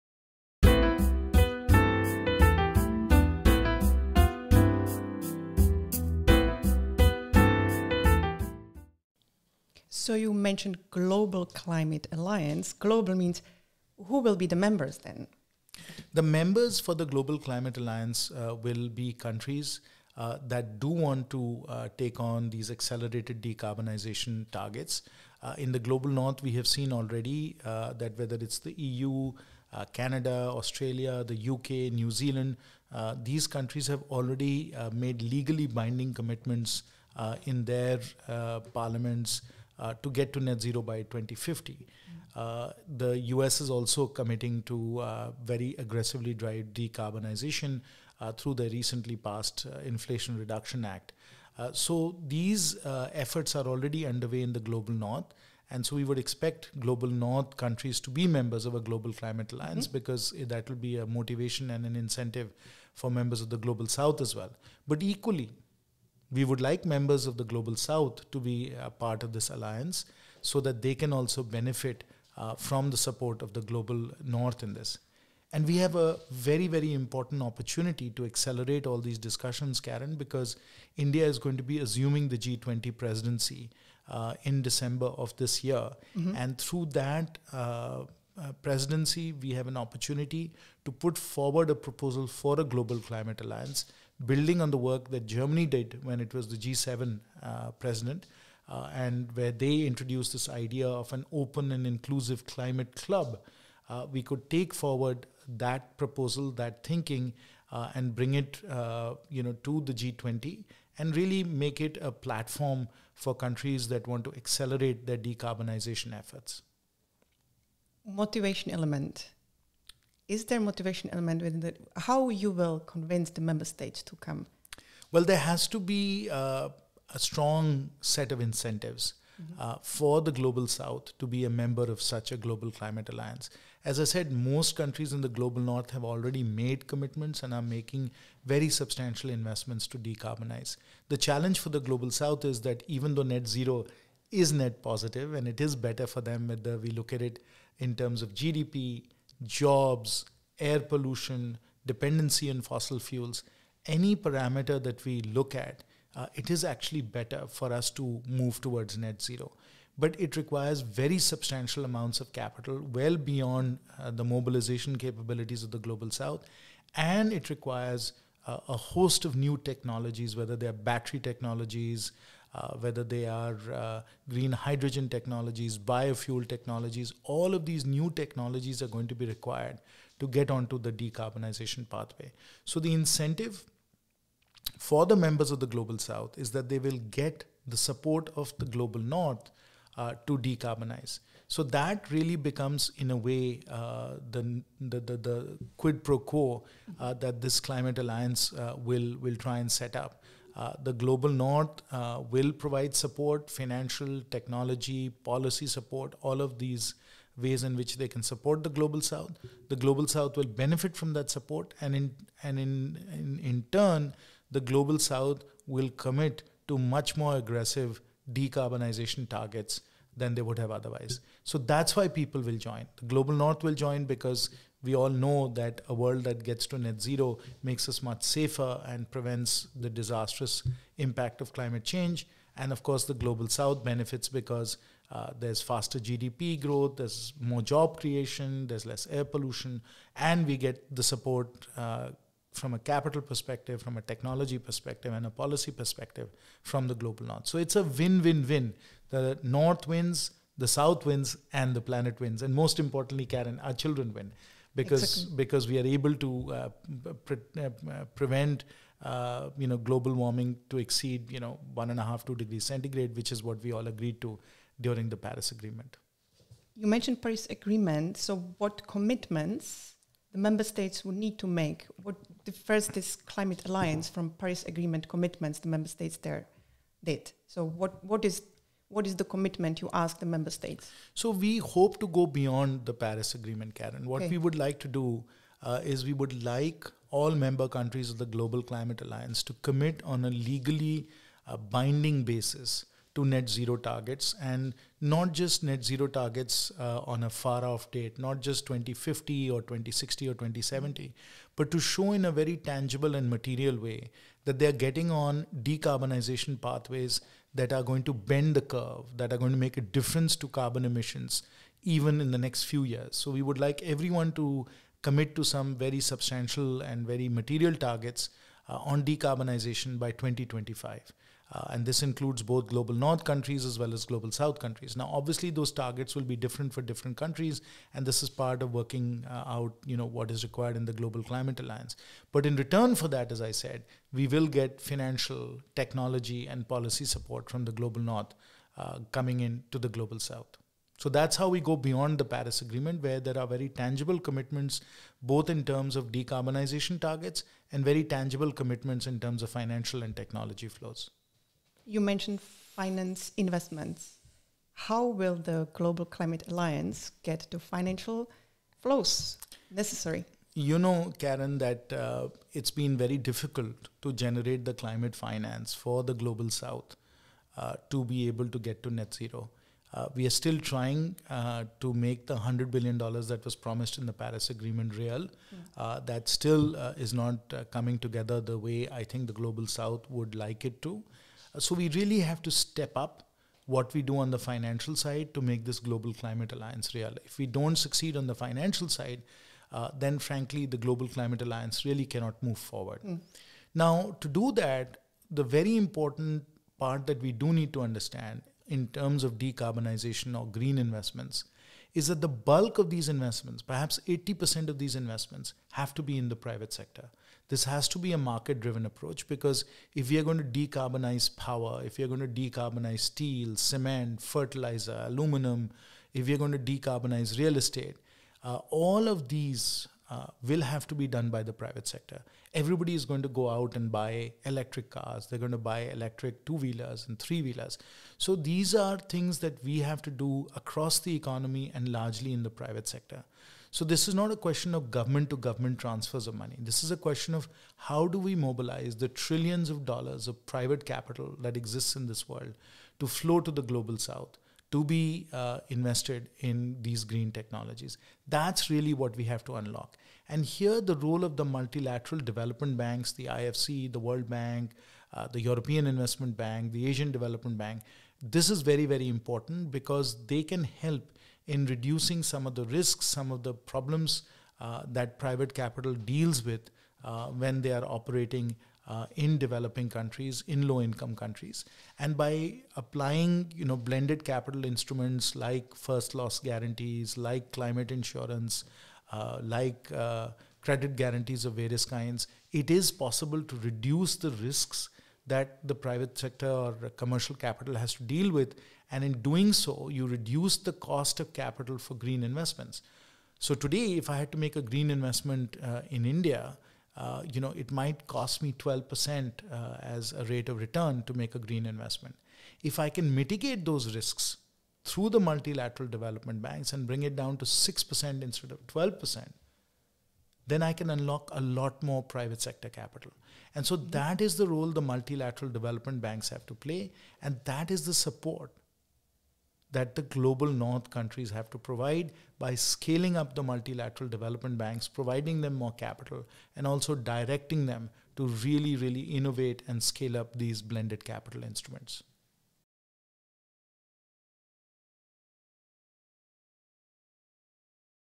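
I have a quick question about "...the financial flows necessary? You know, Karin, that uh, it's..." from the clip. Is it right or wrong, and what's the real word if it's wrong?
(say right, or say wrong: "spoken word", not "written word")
right.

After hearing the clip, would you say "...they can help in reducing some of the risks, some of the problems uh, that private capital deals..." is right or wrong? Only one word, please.
right.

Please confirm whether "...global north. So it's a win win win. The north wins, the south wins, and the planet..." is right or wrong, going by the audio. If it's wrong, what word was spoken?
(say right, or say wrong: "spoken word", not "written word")
right.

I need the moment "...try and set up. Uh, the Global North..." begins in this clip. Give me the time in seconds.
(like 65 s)
199 s.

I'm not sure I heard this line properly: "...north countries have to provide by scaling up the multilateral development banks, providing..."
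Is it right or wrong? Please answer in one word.
right.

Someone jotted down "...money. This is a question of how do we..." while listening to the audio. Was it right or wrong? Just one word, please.
right.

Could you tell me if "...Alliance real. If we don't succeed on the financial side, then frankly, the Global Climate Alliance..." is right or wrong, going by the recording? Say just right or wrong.
right.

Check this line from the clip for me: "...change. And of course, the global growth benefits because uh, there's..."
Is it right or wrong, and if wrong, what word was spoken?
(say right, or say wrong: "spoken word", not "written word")
wrong: "south", not "growth".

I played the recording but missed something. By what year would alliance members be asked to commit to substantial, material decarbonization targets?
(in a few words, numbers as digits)
2025.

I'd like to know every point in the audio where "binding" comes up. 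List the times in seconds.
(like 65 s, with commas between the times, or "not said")
35 s, 291 s.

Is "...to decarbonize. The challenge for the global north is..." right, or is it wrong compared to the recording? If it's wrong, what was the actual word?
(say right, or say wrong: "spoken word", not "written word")
wrong: "south", not "north".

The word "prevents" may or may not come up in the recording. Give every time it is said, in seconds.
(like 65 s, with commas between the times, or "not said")
229 s, 258 s.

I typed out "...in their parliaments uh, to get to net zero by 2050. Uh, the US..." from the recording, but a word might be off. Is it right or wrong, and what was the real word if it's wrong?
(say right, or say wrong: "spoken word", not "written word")
right.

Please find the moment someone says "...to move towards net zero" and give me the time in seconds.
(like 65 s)
157 s.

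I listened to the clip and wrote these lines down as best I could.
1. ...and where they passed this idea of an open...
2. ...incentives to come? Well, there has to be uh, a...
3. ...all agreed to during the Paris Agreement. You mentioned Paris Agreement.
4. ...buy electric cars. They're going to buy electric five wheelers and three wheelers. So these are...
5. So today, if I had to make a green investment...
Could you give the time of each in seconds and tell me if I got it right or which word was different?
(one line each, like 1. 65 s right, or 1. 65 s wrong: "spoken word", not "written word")
1. 98 s wrong: "introduced", not "passed"
2. 123 s wrong: "states", not "incentives"
3. 263 s right
4. 423 s wrong: "two", not "five"
5. 493 s right.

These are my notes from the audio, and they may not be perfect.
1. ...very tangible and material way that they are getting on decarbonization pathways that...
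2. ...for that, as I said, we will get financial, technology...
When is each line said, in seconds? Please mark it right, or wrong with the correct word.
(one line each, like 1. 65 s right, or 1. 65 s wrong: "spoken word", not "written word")
1. 302 s right
2. 332 s right.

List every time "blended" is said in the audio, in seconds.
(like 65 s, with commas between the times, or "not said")
473 s, 530 s.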